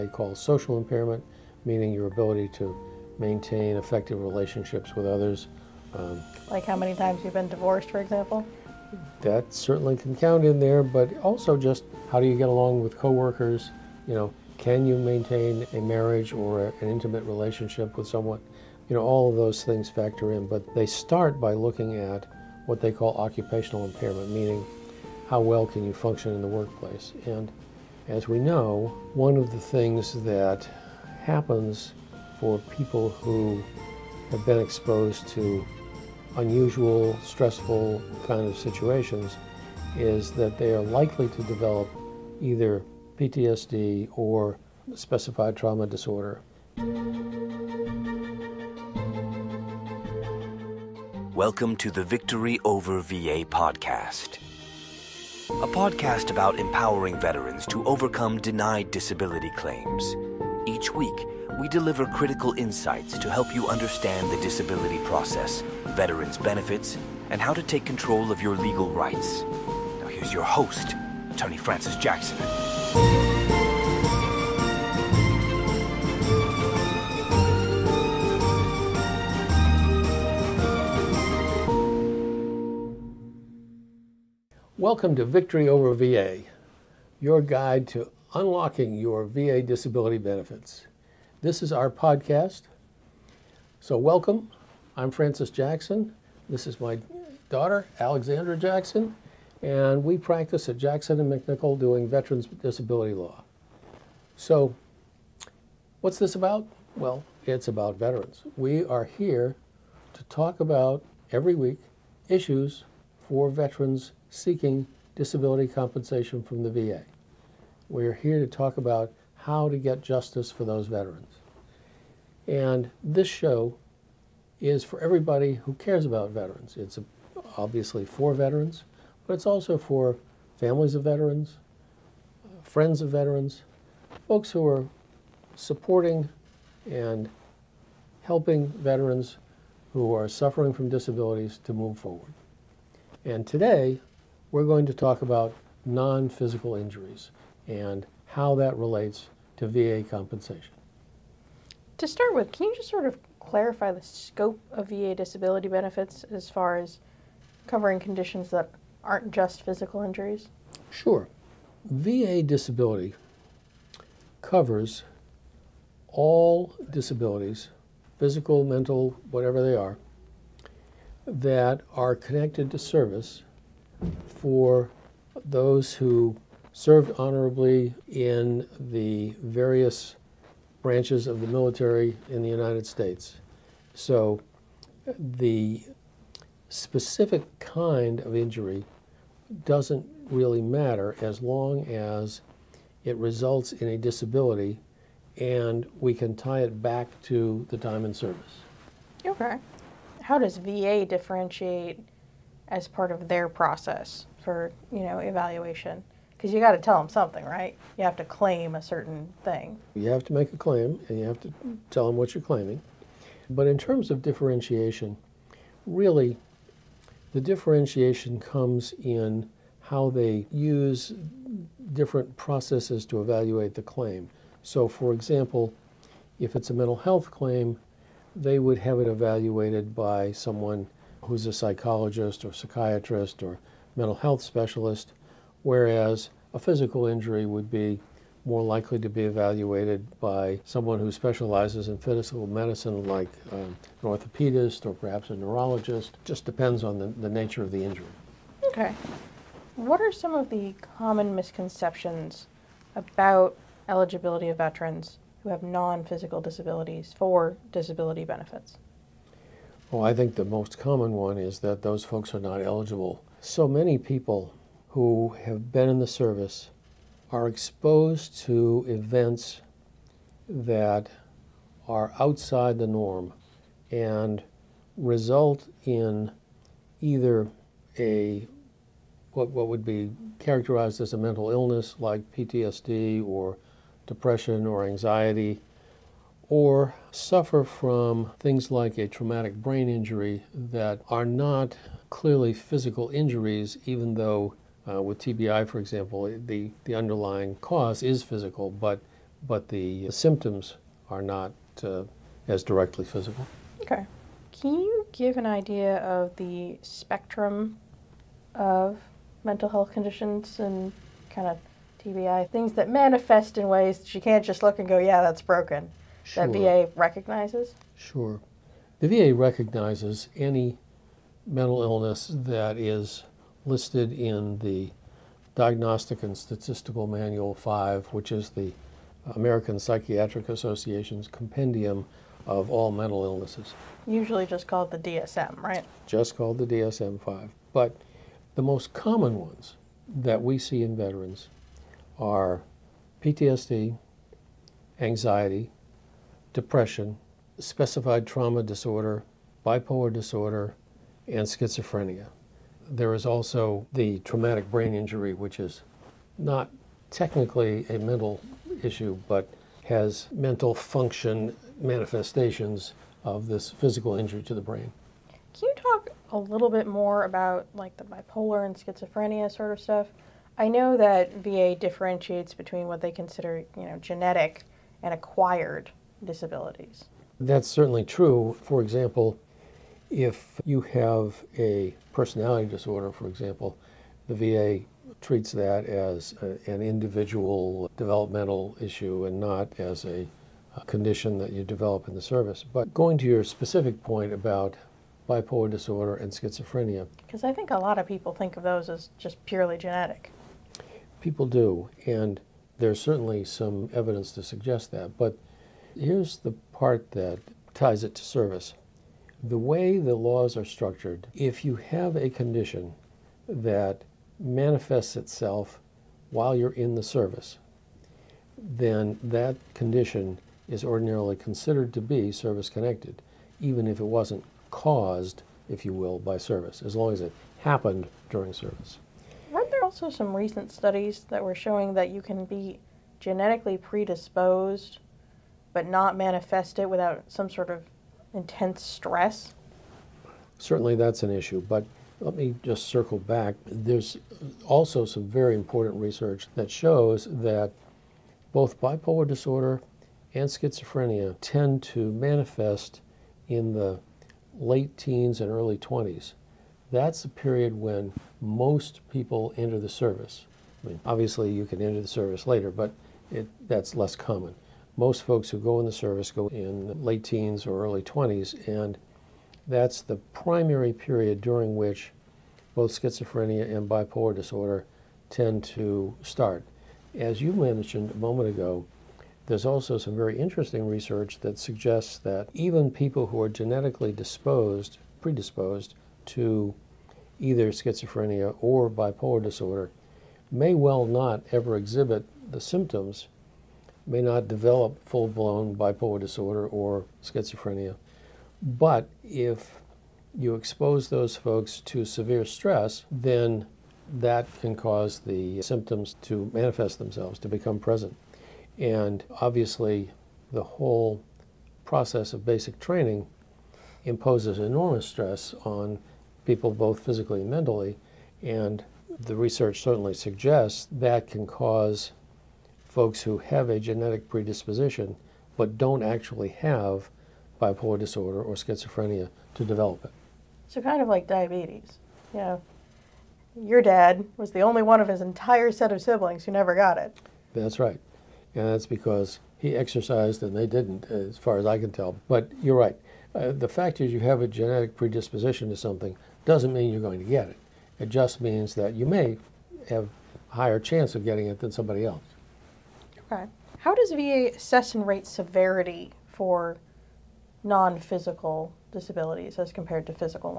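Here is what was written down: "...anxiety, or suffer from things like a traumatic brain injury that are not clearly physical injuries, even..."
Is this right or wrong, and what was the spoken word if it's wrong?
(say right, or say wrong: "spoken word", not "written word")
right.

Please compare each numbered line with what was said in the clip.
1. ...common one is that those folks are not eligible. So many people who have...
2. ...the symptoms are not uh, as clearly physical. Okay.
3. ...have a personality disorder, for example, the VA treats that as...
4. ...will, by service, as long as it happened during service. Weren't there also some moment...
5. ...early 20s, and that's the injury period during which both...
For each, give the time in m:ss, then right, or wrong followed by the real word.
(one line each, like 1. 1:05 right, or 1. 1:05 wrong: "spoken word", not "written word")
1. 4:20 right
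2. 4:59 wrong: "directly", not "clearly"
3. 6:20 right
4. 7:05 wrong: "recent", not "moment"
5. 7:47 wrong: "primary", not "injury".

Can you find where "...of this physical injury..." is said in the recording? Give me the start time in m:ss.
6:03.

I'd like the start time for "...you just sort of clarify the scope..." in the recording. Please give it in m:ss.
2:32.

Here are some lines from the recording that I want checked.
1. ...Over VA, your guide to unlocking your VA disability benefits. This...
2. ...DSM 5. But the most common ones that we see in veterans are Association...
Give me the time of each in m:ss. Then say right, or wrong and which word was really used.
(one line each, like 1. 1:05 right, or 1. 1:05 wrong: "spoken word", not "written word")
1. 1:25 right
2. 5:36 wrong: "PTSD", not "Association".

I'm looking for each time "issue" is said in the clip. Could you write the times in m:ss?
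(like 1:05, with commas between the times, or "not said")
1:52, 5:58, 6:28, 7:21.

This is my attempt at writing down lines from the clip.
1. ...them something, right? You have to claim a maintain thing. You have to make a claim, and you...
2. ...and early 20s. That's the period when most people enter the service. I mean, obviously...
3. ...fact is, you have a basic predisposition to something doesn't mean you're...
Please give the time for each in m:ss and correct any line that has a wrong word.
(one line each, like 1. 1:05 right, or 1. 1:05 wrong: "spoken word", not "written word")
1. 3:26 wrong: "certain", not "maintain"
2. 7:35 right
3. 9:03 wrong: "genetic", not "basic".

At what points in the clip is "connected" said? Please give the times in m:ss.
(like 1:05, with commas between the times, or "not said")
2:52, 7:02.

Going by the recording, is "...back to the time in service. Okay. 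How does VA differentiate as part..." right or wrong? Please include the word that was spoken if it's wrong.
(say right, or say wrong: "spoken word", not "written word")
right.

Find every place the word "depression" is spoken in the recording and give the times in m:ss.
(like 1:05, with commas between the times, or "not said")
4:44, 5:46.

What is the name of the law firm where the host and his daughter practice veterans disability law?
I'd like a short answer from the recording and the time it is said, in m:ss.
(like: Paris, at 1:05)
Jackson and MacNichol, at 1:40.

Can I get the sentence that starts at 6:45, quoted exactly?
But here's the part that ties it to service.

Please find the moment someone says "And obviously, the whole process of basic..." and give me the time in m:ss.
8:28.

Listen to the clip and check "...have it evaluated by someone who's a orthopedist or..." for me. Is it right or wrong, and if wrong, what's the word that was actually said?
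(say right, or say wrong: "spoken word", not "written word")
wrong: "psychologist", not "orthopedist".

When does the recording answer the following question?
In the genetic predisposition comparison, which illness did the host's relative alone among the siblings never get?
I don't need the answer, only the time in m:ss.
8:51.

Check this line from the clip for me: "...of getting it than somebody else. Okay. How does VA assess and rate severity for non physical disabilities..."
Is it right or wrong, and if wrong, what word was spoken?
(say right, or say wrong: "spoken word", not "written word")
right.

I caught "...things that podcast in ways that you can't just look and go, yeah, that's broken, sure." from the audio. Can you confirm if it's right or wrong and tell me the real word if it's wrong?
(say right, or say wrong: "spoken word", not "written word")
wrong: "manifest", not "podcast".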